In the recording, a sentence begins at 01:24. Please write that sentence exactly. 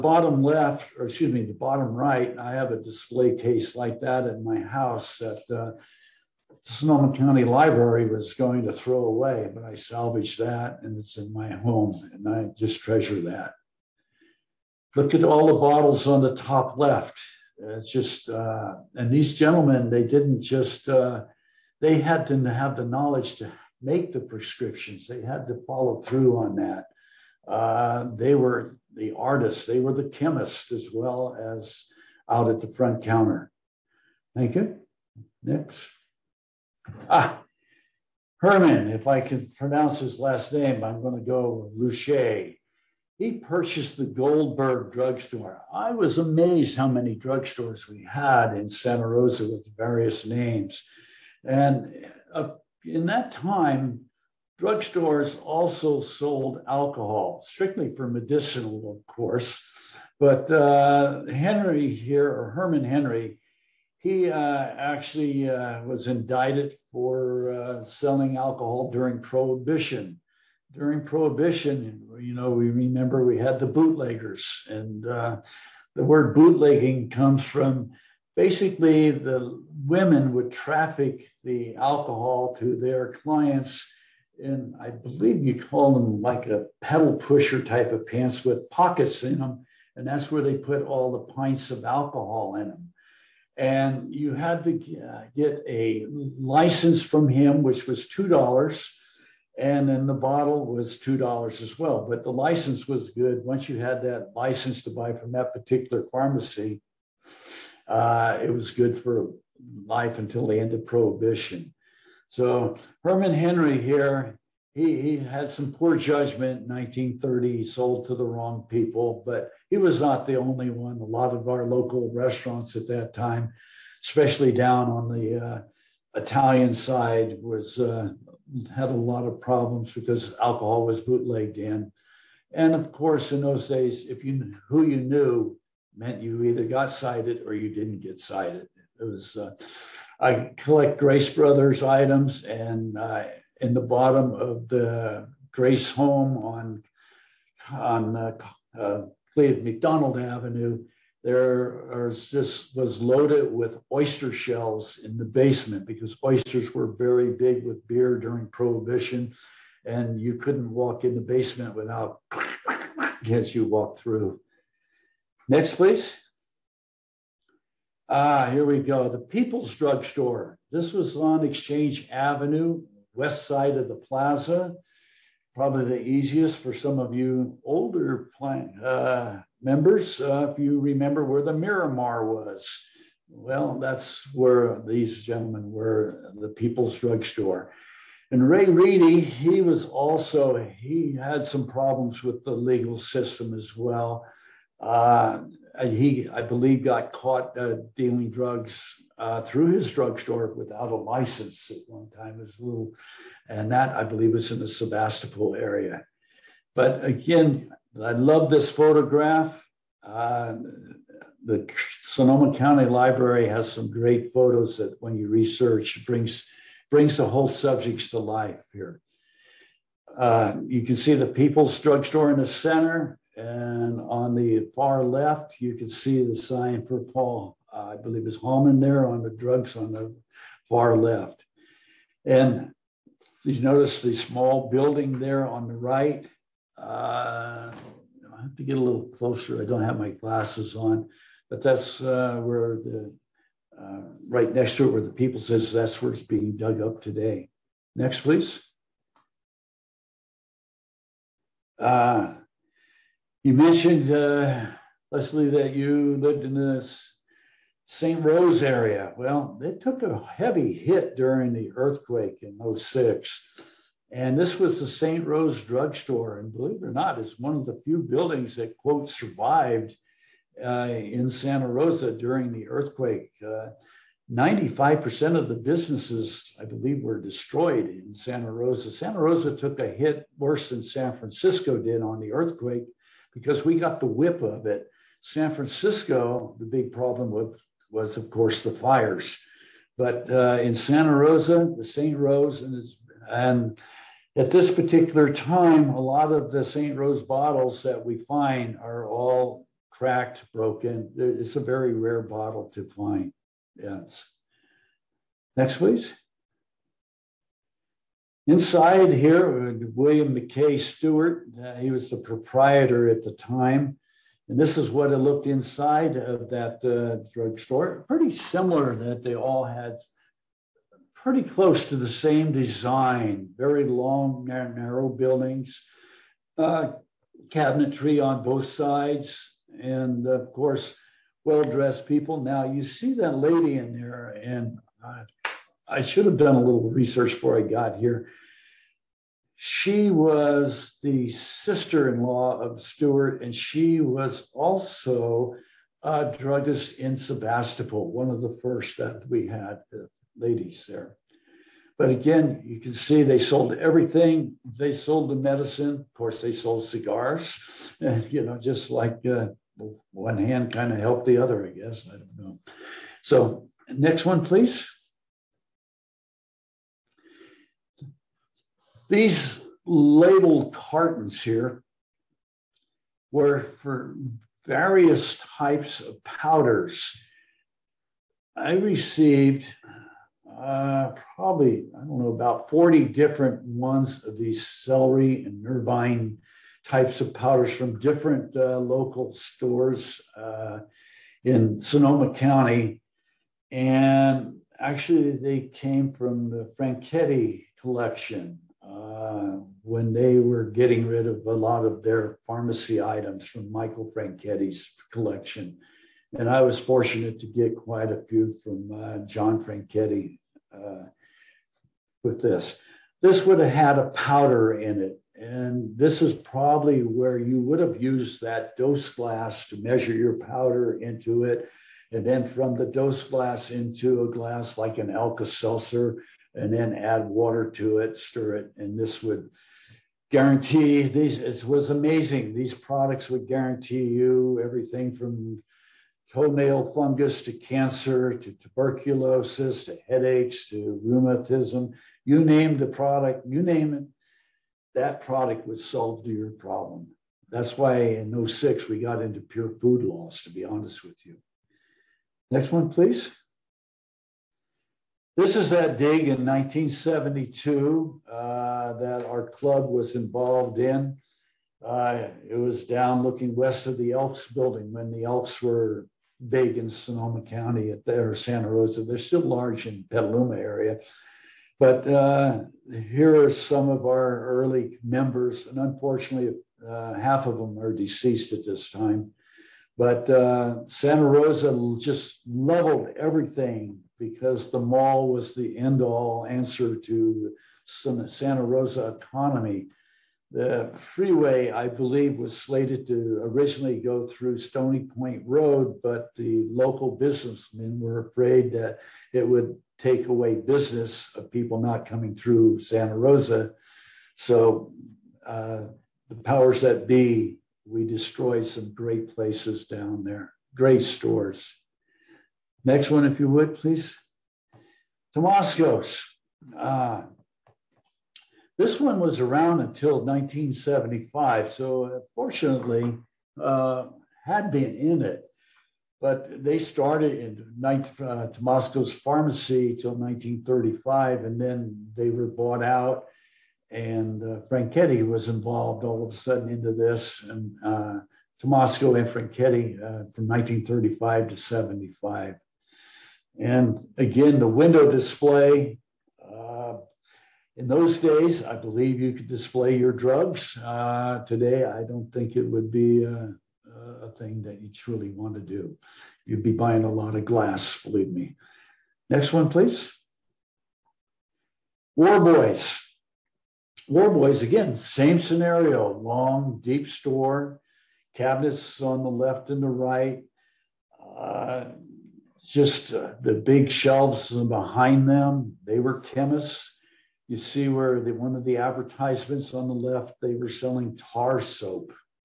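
And I believe you call them like a pedal pusher type of pants with pockets in them.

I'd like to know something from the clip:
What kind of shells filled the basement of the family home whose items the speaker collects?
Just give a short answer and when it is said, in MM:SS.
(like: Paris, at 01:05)
oyster shells, at 02:33.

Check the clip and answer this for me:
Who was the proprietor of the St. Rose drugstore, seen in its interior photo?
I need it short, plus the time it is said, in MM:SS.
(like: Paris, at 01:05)
William McKay Stewart, at 05:09.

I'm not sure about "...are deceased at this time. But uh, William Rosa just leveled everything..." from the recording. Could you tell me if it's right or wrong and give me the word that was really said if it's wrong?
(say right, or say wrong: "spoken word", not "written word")
wrong: "Santa", not "William".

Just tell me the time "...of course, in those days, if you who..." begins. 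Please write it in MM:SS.
02:12.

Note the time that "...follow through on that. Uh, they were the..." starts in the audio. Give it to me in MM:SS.
00:25.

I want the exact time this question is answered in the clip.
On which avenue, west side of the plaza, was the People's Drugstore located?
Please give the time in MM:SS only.
02:51.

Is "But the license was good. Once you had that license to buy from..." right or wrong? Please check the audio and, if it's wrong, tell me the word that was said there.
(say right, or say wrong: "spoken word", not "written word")
right.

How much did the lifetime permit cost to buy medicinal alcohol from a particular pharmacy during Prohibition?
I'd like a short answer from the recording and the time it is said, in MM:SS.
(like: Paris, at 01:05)
$2, at 01:38.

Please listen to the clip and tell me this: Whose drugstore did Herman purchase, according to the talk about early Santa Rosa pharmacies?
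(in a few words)
Goldberg.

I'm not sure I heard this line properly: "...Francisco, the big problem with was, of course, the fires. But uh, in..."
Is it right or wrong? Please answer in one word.
right.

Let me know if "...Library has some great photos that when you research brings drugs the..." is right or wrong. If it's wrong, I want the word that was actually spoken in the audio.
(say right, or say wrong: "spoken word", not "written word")
wrong: "brings", not "drugs".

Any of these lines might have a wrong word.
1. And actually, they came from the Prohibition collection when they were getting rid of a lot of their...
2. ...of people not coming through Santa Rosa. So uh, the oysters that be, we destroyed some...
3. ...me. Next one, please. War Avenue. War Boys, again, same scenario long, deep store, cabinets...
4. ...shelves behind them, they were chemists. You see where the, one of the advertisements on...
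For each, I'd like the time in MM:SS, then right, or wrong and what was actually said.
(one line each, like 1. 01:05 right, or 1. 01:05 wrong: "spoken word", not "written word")
1. 06:33 wrong: "Franchetti", not "Prohibition"
2. 08:21 wrong: "powers", not "oysters"
3. 09:18 wrong: "Boys", not "Avenue"
4. 09:33 right.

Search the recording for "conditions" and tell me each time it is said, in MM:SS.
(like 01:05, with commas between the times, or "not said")
not said.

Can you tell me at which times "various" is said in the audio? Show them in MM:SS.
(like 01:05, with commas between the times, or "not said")
00:49, 06:14.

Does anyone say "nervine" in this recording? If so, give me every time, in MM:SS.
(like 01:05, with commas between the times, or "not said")
06:25.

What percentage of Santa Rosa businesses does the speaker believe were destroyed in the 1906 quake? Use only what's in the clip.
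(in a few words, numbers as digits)
95%.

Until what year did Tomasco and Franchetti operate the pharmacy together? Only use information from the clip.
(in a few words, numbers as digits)
1975.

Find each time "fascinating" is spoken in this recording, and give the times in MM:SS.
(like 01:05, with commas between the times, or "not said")
not said.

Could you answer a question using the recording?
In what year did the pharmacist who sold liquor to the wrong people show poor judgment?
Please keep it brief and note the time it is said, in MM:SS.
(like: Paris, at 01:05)
1930, at 01:56.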